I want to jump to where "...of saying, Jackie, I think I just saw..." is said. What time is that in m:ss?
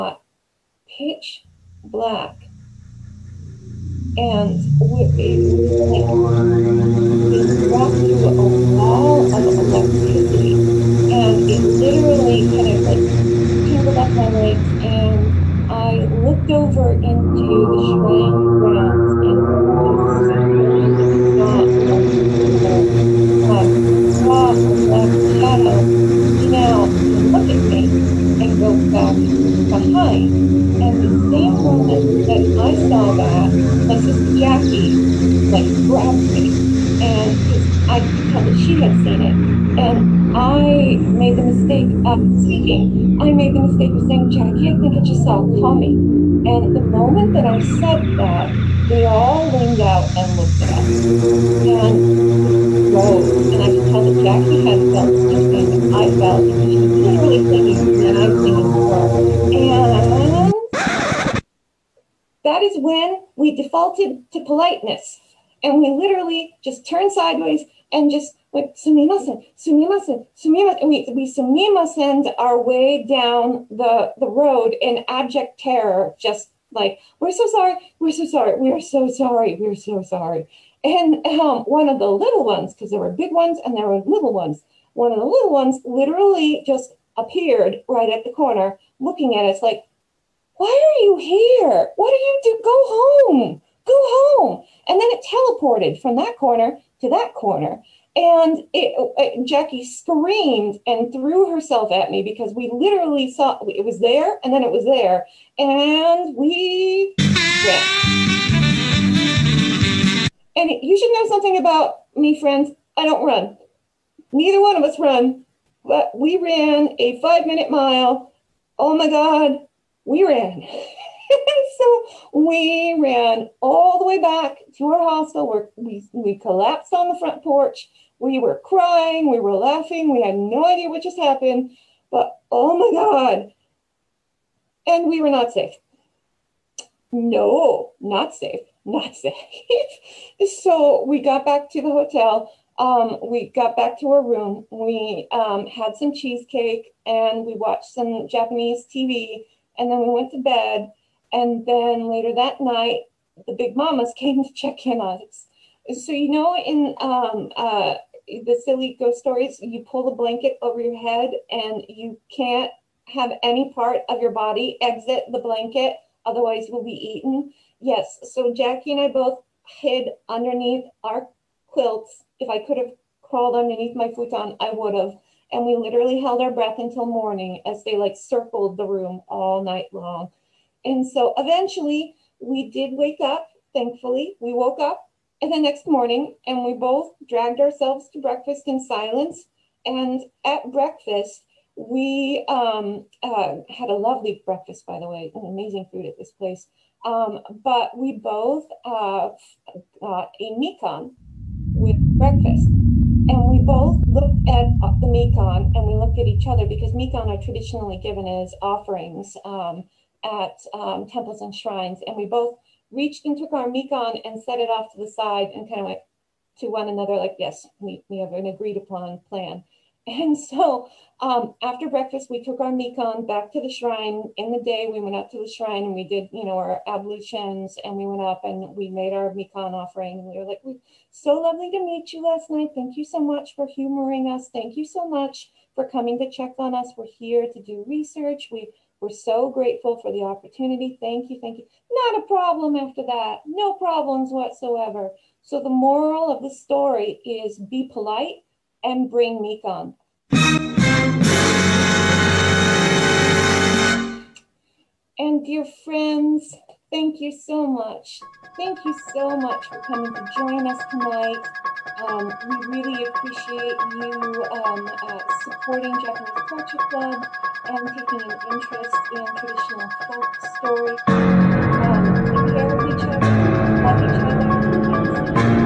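0:43.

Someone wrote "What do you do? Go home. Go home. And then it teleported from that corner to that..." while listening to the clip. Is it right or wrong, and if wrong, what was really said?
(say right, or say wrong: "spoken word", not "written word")
right.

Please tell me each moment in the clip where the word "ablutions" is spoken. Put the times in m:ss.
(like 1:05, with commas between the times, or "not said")
3:46.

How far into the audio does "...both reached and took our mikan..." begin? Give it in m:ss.
3:32.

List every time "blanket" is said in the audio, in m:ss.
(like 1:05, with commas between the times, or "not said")
2:40, 2:45.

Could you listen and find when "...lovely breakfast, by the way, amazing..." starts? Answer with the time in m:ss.
3:13.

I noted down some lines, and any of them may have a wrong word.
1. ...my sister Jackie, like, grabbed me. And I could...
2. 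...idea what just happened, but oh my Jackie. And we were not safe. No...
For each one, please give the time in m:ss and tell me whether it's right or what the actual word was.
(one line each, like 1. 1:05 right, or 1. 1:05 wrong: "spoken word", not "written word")
1. 0:33 right
2. 2:10 wrong: "God", not "Jackie".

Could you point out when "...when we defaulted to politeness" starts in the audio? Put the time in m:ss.
1:02.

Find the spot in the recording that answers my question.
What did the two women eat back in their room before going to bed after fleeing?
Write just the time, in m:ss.
2:26.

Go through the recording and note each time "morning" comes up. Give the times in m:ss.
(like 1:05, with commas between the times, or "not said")
2:57, 3:05.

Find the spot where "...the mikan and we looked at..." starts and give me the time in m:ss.
3:24.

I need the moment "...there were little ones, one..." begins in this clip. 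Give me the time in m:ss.
1:23.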